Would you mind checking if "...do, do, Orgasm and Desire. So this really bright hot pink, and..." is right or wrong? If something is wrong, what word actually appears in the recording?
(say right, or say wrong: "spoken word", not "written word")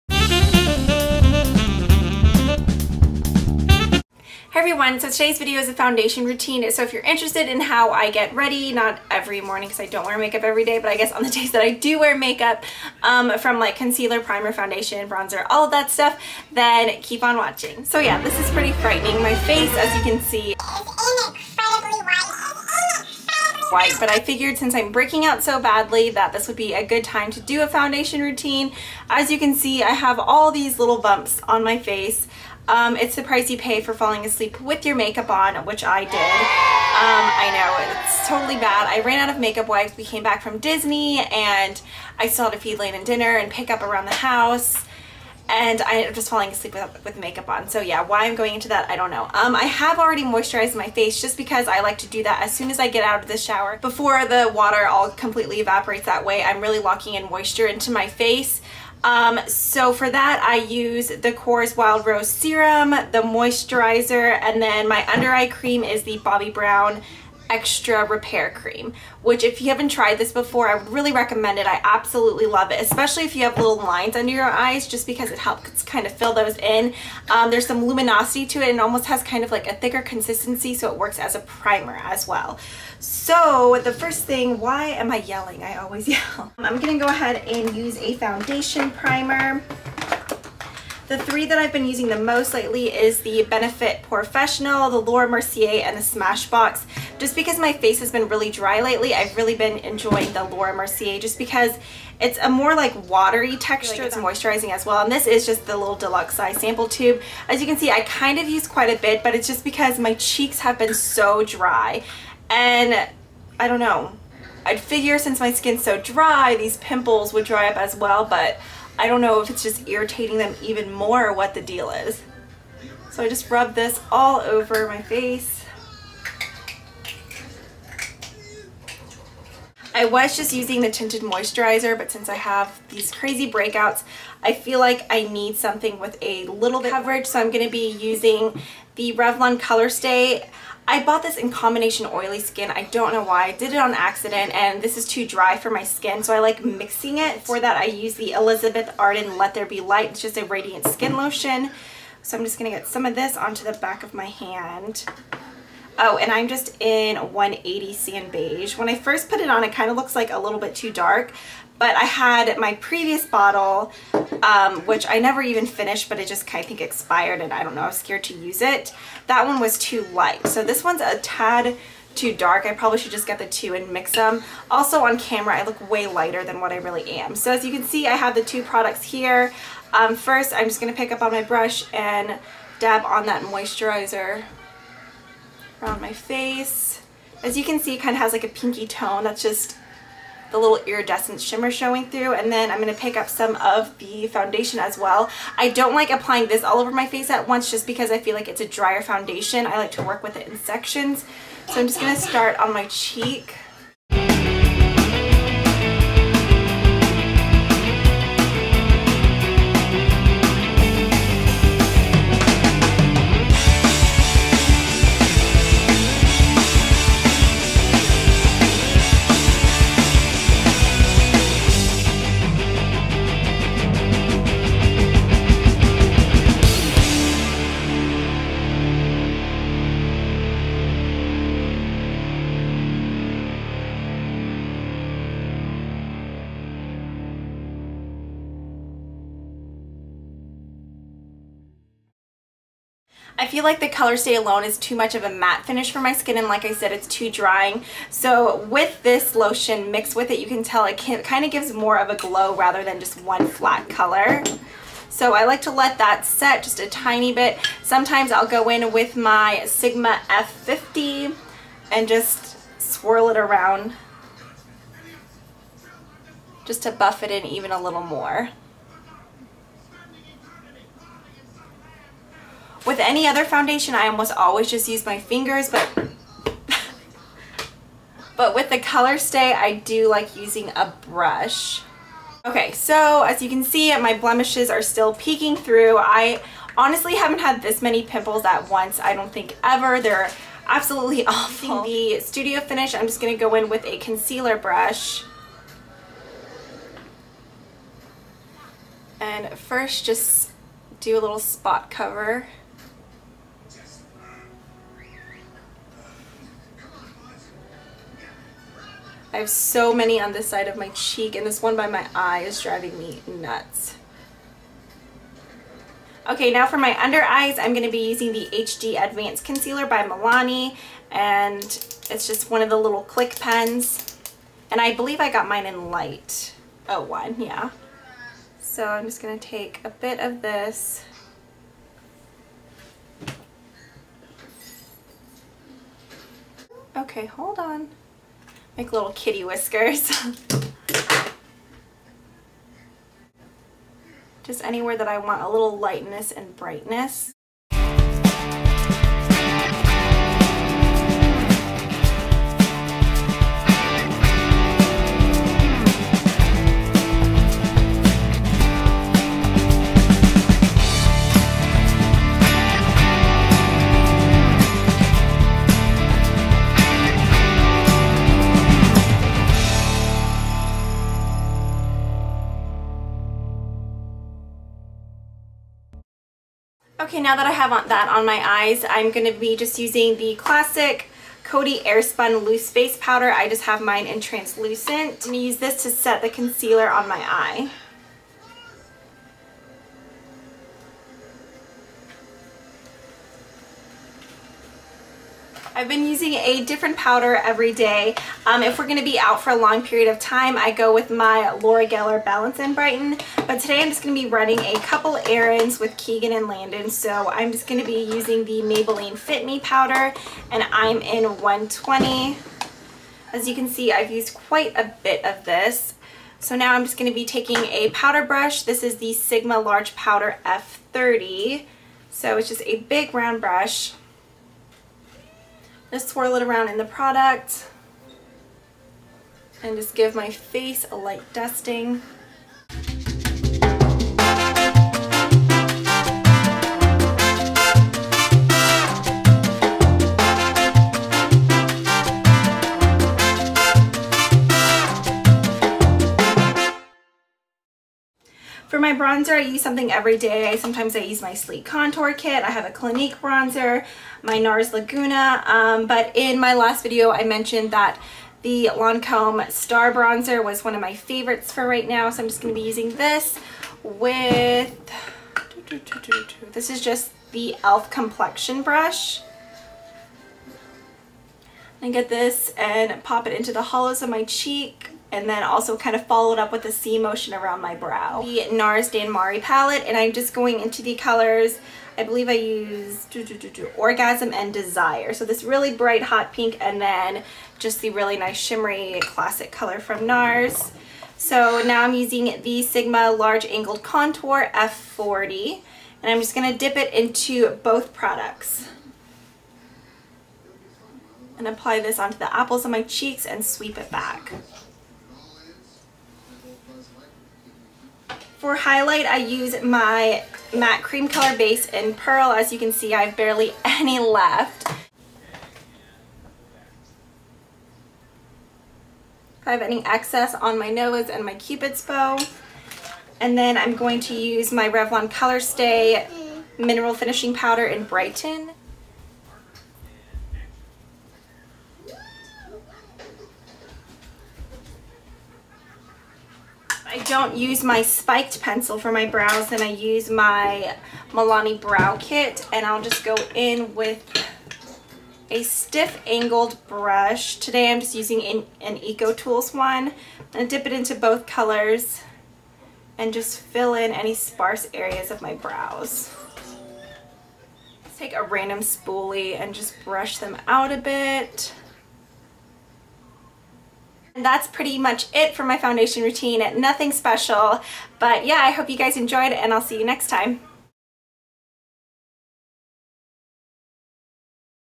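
right.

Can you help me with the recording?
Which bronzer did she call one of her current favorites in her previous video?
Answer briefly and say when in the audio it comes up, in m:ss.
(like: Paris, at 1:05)
Lancome Star Bronzer, at 7:38.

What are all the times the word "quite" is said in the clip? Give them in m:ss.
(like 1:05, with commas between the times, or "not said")
1:48, 6:54.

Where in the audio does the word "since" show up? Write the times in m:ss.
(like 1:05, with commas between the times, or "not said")
0:24, 1:55, 2:12.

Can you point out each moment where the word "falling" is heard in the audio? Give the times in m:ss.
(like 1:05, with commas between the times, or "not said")
0:33, 0:46.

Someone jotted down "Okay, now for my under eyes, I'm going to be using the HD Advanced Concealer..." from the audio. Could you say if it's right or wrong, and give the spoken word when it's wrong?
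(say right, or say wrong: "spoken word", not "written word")
right.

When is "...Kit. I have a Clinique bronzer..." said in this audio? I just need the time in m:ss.
7:32.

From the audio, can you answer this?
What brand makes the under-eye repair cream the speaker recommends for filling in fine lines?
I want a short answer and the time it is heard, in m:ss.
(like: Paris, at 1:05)
Bobbi Brown, at 1:06.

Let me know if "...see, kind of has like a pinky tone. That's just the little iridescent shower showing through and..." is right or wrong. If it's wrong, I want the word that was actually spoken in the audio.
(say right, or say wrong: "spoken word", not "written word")
wrong: "shimmer", not "shower".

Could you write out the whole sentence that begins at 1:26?
I'm gonna go ahead and use a foundation primer.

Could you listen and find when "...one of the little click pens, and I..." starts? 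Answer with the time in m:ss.
5:22.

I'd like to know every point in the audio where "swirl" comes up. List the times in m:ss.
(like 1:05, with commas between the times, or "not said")
4:22, 7:06.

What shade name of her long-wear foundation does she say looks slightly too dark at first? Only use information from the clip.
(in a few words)
180 Sand Beige.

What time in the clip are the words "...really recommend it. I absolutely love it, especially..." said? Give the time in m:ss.
1:10.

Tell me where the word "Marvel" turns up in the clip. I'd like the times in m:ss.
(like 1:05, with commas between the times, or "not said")
not said.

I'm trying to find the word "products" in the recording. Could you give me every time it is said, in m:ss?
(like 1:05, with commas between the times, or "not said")
2:58, 7:06, 8:17.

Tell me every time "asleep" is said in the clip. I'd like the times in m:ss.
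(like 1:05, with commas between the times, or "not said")
0:34, 0:46.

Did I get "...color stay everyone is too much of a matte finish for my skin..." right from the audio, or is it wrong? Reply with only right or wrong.
wrong.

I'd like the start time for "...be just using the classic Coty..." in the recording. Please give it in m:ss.
6:19.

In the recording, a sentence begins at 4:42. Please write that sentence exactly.
Okay, so as you can see, my blemishes are still peeking through.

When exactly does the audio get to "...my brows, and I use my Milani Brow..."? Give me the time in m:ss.
8:58.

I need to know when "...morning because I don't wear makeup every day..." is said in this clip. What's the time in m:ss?
0:09.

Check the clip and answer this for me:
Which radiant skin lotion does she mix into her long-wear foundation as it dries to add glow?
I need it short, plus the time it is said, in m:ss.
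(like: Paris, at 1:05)
Elizabeth Arden Let There Be Light, at 2:28.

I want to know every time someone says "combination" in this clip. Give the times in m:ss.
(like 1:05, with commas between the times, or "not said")
2:21.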